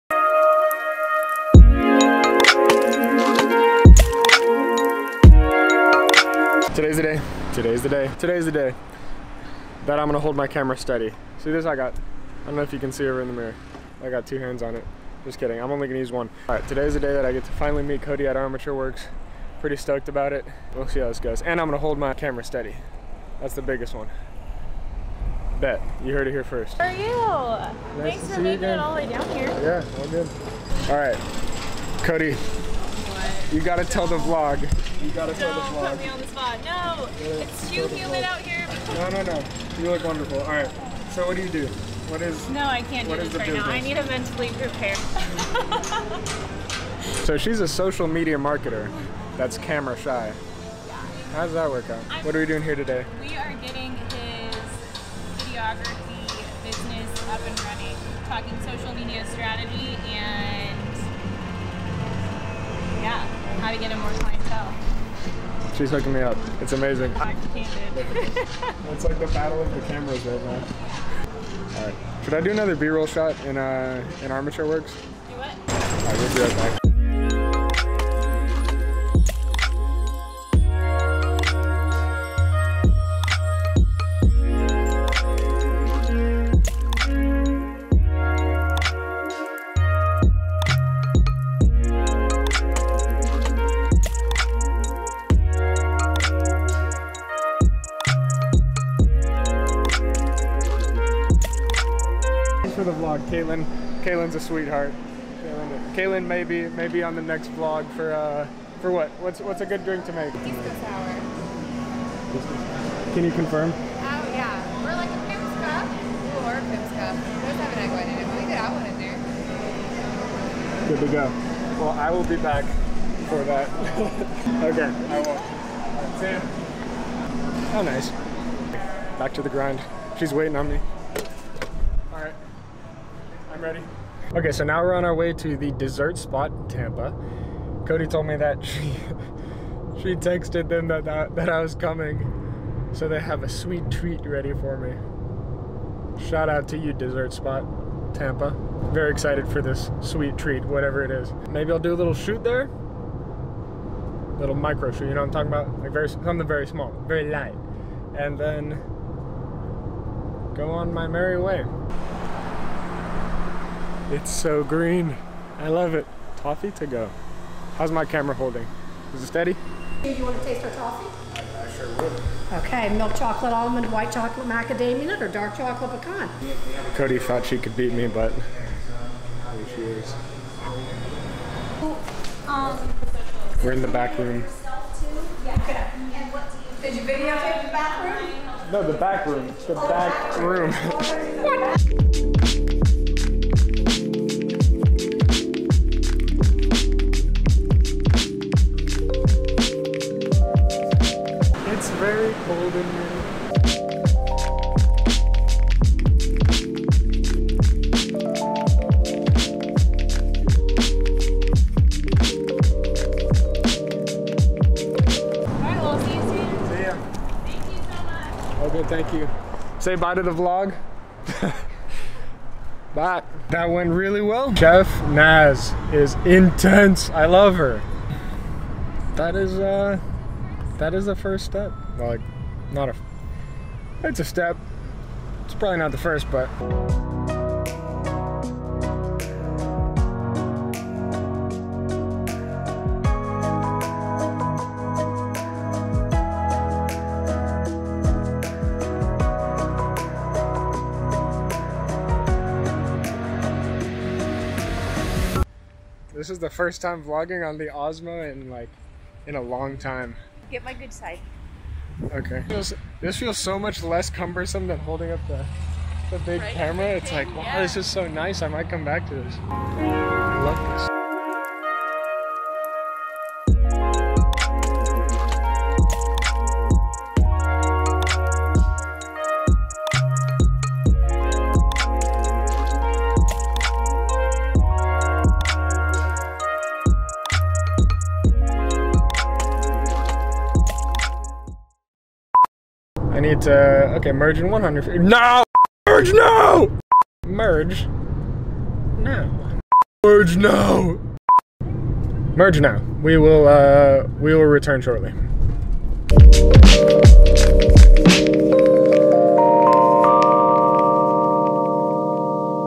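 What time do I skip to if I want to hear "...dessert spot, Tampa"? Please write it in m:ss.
2:26.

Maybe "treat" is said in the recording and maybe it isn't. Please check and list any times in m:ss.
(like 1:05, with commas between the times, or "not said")
2:23, 2:30.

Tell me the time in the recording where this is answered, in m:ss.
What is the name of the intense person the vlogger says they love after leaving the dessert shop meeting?
3:44.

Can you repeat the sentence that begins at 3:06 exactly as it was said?
Did you videotape the back room?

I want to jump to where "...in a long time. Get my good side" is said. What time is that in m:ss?
4:19.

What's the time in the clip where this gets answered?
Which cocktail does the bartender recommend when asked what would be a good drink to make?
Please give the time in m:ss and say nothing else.
1:50.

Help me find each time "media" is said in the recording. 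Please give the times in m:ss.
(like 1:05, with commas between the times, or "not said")
0:48, 0:58.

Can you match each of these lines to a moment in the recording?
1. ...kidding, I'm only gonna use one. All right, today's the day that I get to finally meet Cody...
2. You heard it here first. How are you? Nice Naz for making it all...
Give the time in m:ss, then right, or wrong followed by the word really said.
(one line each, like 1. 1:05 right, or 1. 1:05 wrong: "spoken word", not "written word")
1. 0:15 right
2. 0:26 wrong: "Thanks", not "Naz".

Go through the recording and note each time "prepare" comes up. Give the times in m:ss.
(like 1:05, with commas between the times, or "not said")
0:44.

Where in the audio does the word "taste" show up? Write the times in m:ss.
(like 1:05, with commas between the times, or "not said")
2:50.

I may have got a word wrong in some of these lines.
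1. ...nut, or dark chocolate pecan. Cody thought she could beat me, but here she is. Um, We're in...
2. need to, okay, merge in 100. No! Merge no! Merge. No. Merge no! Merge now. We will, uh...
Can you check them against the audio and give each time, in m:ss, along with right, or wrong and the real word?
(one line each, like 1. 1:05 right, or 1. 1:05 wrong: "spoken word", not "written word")
1. 2:55 right
2. 4:53 right.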